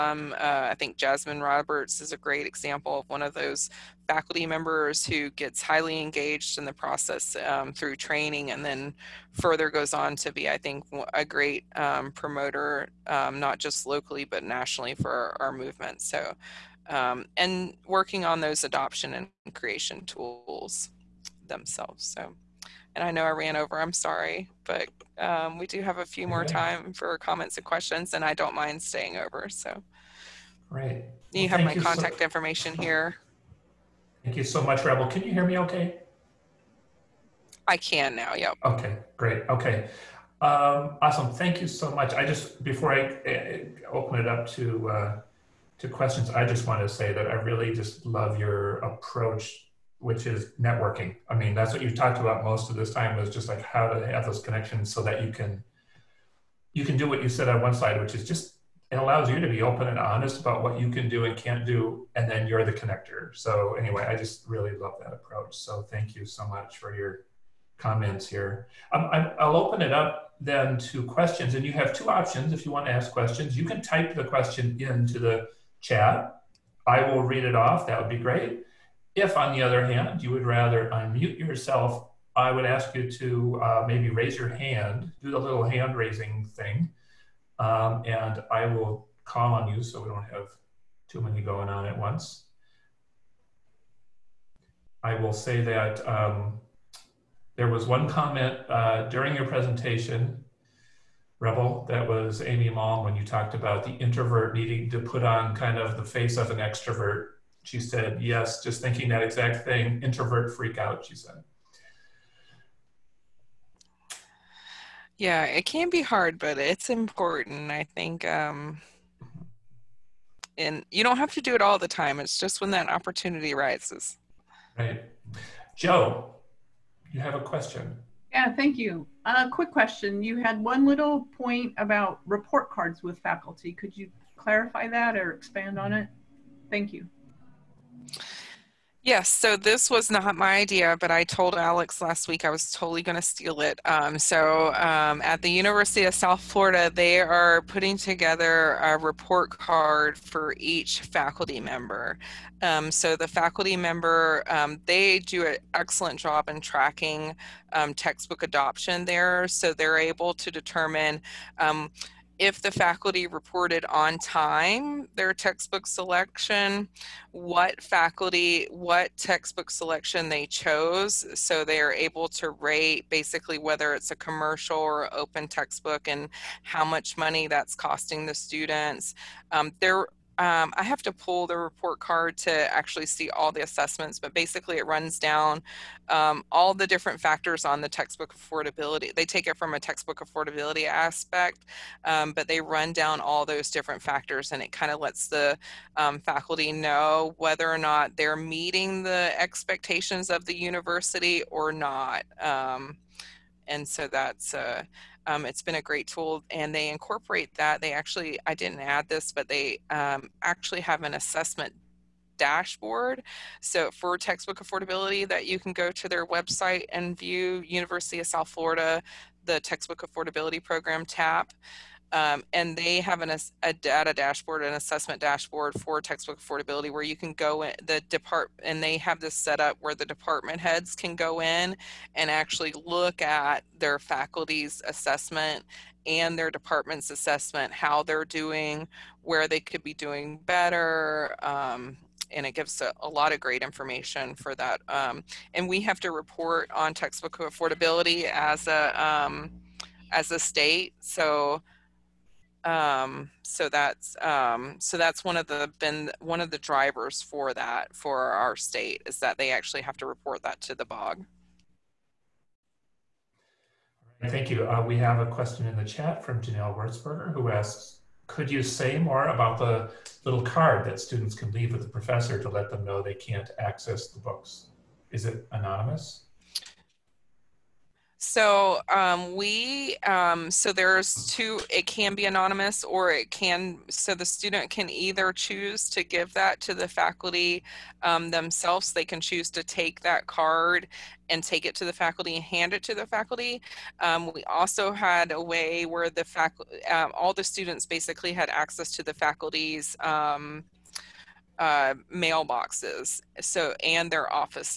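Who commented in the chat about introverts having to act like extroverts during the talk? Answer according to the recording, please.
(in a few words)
Amy Malm.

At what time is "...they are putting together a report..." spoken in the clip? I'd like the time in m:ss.
2:26.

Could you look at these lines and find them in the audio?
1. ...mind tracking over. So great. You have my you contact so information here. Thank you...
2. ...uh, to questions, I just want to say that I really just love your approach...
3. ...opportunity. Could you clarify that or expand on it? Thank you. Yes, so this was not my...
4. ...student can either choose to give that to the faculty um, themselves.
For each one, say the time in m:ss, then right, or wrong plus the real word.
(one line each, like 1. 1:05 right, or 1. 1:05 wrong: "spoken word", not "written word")
1. 0:28 wrong: "staying", not "tracking"
2. 0:44 right
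3. 2:13 wrong: "faculty", not "opportunity"
4. 4:44 right.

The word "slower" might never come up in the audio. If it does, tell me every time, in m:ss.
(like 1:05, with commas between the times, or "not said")
not said.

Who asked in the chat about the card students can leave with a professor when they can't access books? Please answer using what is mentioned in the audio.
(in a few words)
Janelle Wurzberger.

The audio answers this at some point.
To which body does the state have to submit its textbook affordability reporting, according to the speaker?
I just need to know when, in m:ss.
4:20.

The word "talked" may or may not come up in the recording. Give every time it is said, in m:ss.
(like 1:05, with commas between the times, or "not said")
0:51, 1:43.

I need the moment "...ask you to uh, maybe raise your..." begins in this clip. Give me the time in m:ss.
1:22.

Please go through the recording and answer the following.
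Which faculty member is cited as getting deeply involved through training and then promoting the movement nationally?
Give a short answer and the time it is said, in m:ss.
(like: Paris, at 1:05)
Jasmine Roberts, at 0:00.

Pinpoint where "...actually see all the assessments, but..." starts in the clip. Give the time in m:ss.
3:02.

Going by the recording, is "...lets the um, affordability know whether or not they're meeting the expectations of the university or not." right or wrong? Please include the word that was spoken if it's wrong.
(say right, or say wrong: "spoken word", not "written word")
wrong: "faculty", not "affordability".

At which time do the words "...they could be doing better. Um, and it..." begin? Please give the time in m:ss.
3:59.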